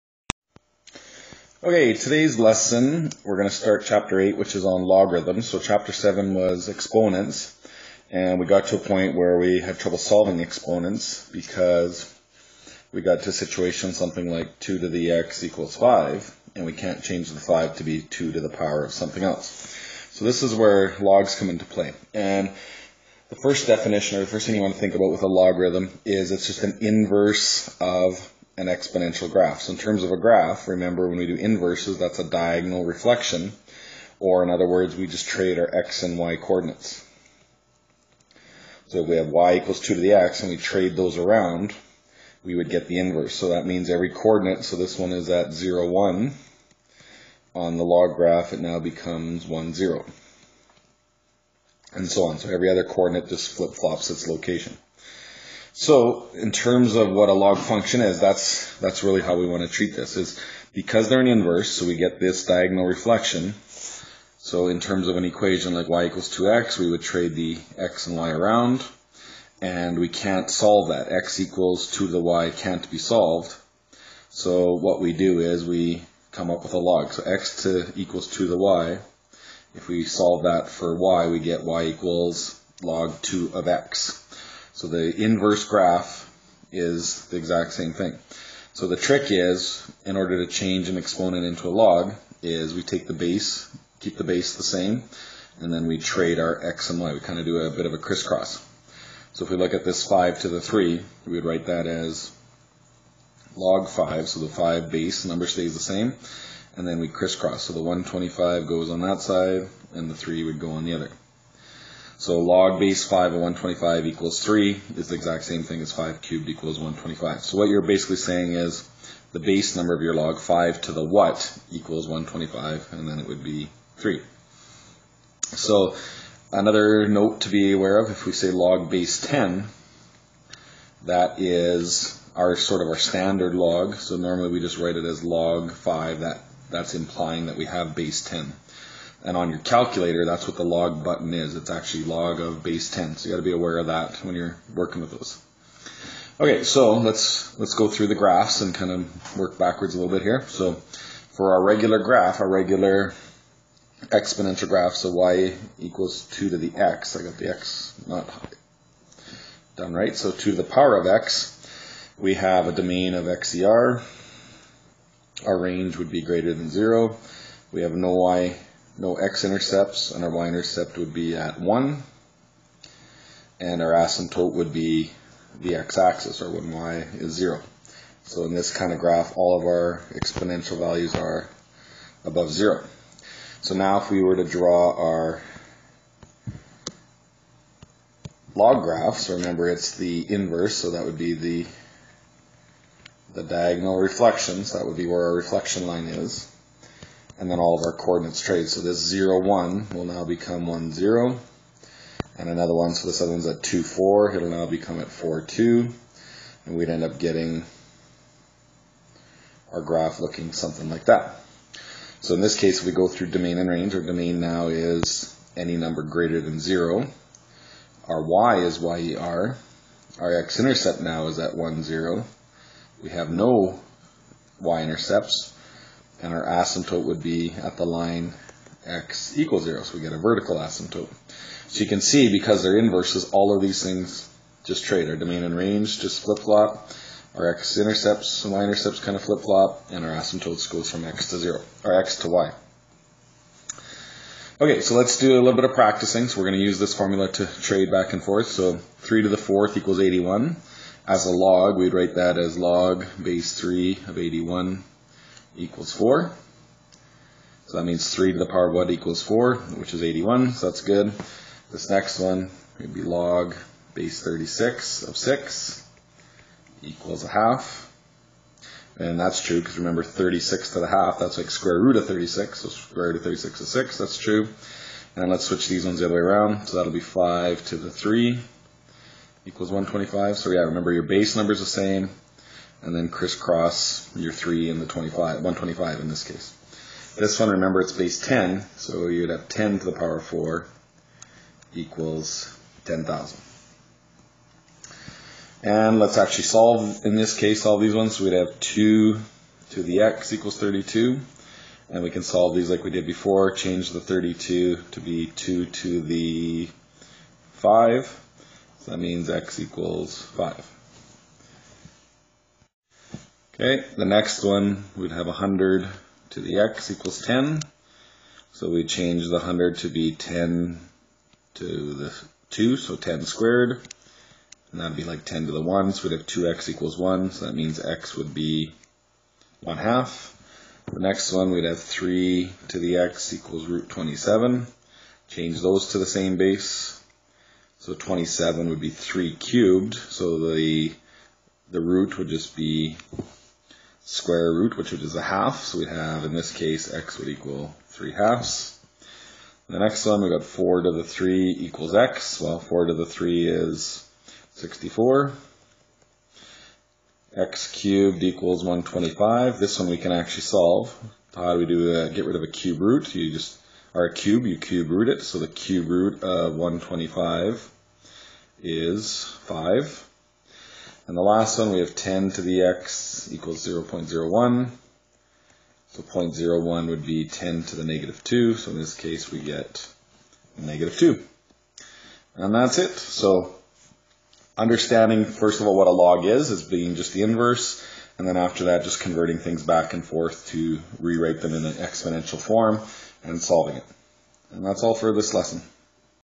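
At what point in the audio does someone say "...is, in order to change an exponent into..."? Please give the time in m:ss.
1:29.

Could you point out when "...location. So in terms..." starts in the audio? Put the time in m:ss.
0:54.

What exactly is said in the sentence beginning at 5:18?
So we change the 100 to be 10 to the 2, so 10 squared.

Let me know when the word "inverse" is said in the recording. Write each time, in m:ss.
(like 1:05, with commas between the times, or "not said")
0:26, 0:31, 0:42, 1:01, 1:25, 3:10, 3:52, 6:27.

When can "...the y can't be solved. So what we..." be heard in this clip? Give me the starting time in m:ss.
1:12.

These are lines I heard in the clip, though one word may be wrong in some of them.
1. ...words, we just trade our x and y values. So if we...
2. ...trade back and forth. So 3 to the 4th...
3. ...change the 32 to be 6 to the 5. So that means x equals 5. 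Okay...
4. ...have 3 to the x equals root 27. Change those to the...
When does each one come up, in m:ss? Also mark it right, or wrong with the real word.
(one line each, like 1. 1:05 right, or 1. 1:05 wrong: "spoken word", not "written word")
1. 0:34 wrong: "coordinates", not "values"
2. 4:07 right
3. 5:03 wrong: "2", not "6"
4. 5:31 right.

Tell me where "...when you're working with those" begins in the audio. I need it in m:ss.
2:24.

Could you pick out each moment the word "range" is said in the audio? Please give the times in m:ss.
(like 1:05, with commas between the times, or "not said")
2:45, 3:33, 3:55.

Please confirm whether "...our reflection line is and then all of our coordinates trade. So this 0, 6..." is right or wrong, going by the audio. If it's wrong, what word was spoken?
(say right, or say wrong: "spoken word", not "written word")
wrong: "1", not "6".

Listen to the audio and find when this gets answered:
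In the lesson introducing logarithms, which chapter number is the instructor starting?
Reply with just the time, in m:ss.
0:03.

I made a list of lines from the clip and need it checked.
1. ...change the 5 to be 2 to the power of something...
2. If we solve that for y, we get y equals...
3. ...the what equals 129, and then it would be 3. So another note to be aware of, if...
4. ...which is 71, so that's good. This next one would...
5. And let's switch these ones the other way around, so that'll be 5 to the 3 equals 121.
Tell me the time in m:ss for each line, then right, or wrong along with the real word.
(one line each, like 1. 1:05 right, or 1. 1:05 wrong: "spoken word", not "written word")
1. 0:17 right
2. 1:19 right
3. 2:00 wrong: "125", not "129"
4. 4:19 wrong: "81", not "71"
5. 4:35 wrong: "125", not "121".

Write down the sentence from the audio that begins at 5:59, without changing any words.
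This one we can actually solve.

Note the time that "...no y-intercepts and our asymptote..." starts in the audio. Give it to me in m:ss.
3:43.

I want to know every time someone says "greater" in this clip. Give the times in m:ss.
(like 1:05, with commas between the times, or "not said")
2:46, 3:36.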